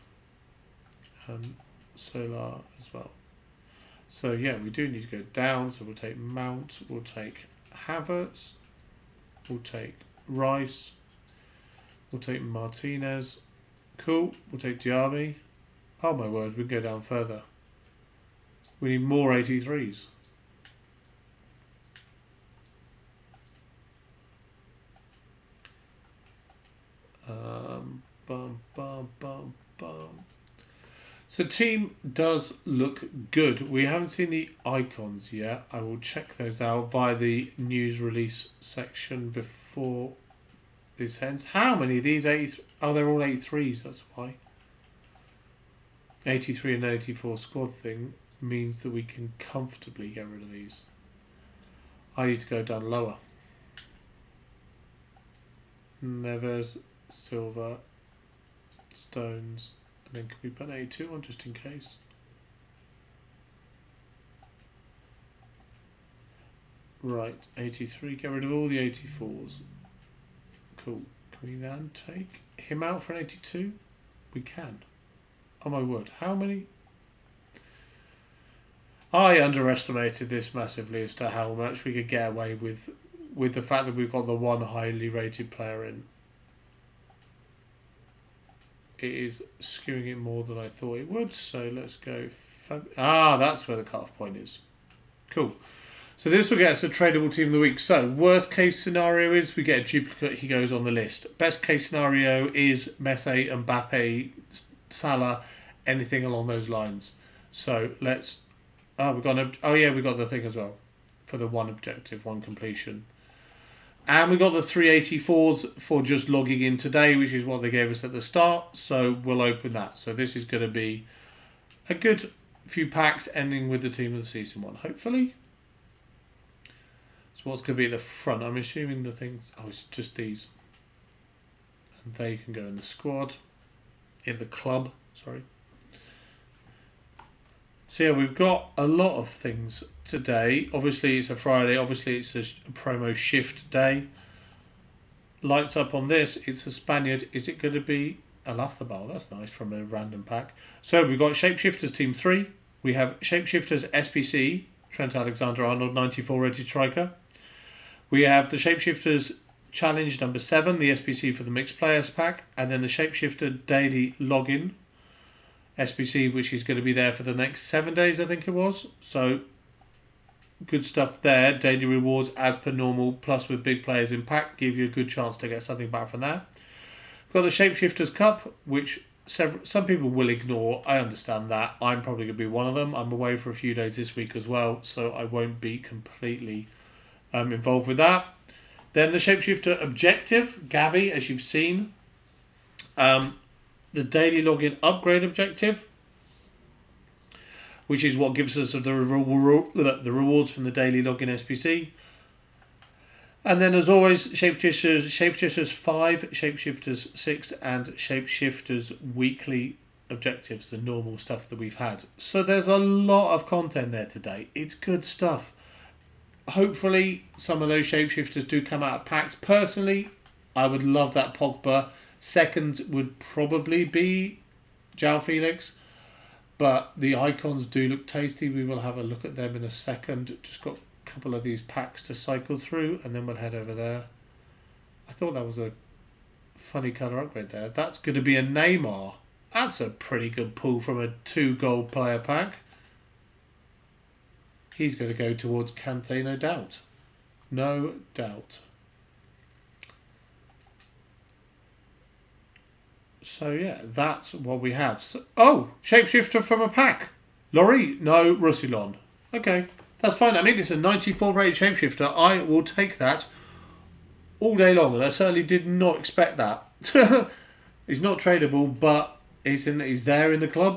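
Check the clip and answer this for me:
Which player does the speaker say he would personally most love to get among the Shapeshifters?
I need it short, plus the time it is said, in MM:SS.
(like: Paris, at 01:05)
Pogba, at 03:41.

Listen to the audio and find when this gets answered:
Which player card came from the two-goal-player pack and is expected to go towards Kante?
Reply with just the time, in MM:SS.
03:58.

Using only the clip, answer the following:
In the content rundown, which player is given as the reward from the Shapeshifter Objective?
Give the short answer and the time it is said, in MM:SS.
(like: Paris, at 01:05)
Gavi, at 03:10.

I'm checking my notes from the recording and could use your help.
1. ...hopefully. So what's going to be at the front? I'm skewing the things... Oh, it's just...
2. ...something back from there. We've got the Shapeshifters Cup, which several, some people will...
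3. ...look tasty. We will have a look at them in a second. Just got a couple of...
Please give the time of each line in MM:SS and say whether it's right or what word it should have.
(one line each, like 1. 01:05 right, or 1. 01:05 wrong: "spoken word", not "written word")
1. 02:04 wrong: "assuming", not "skewing"
2. 02:55 right
3. 03:47 right.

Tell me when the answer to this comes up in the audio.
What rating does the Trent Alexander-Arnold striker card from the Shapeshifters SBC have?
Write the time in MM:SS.
02:35.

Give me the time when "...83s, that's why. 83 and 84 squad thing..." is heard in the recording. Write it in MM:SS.
00:43.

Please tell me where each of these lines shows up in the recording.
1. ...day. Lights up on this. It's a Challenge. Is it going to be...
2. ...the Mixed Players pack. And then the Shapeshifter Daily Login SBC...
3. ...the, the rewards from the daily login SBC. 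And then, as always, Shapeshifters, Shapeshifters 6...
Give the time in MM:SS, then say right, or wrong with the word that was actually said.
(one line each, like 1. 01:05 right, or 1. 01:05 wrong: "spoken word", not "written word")
1. 02:23 wrong: "Spaniard", not "Challenge"
2. 02:41 right
3. 03:18 wrong: "5", not "6".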